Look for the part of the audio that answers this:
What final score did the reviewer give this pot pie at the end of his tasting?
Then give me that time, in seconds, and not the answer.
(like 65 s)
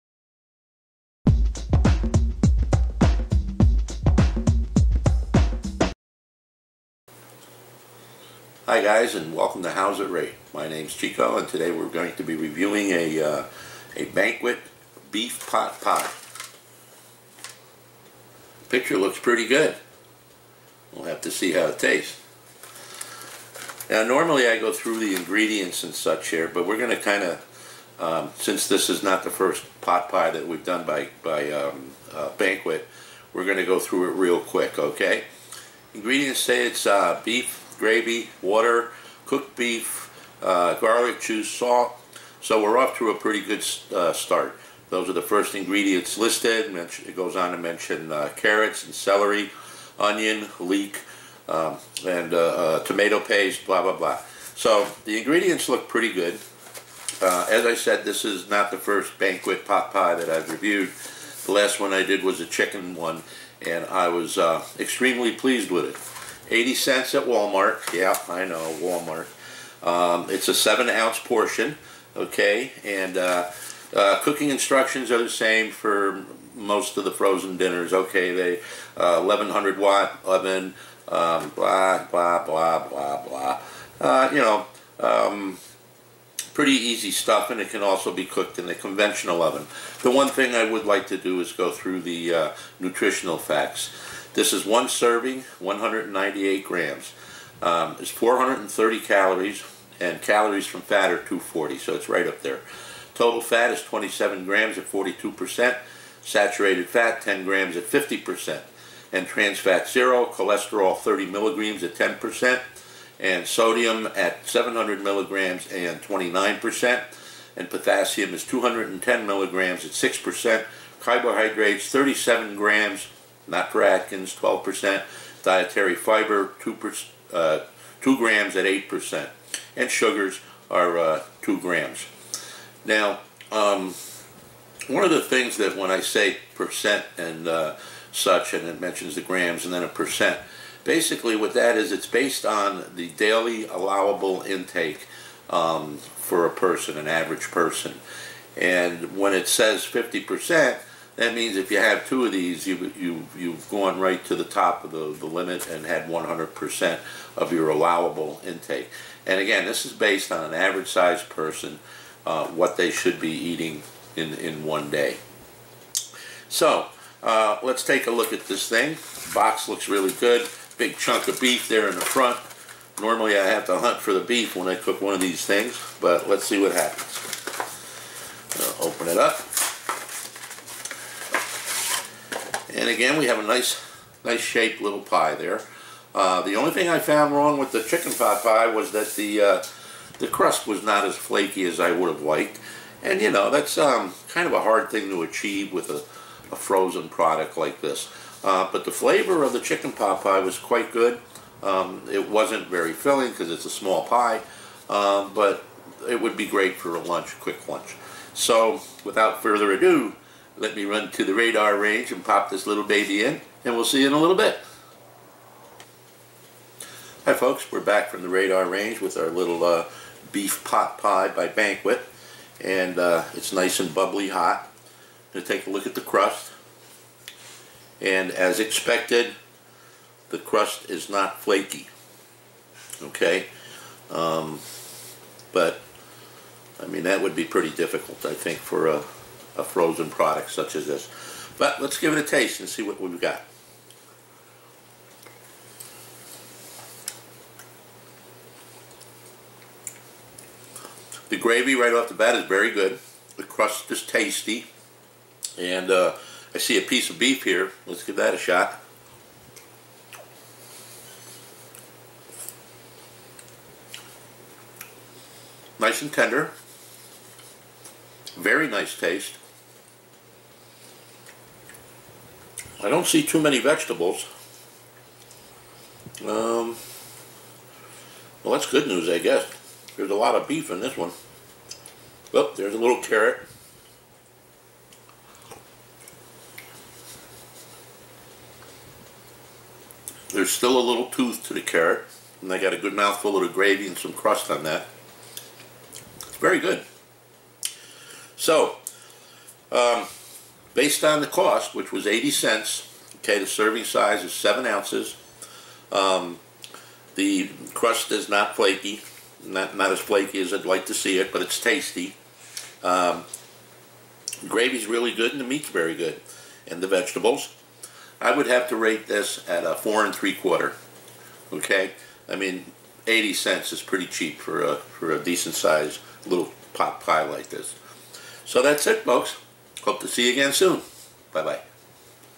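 319 s.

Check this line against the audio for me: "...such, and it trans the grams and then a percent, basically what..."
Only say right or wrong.
wrong.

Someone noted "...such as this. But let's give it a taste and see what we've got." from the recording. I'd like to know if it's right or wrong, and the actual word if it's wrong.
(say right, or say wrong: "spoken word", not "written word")
right.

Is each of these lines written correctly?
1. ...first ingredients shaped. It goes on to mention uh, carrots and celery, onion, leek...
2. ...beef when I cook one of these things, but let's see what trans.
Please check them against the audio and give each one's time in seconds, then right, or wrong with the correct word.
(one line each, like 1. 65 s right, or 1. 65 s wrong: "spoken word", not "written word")
1. 45 s wrong: "listed", not "shaped"
2. 174 s wrong: "happens", not "trans".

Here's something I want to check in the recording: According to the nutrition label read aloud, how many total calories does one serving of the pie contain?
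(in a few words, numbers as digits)
430.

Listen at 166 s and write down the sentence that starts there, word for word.
So, uh, let's take a look at this thing.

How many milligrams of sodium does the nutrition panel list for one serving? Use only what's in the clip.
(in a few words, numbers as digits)
700 milligrams.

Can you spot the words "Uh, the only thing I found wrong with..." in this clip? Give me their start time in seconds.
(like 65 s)
186 s.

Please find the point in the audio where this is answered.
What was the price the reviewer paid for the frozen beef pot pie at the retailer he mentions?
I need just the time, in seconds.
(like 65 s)
66 s.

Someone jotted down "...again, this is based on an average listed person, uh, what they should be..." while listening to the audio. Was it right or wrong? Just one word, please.
wrong.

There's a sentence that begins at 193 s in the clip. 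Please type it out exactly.
And you know, that's um, kind of a hard thing to achieve with a, a frozen product like this.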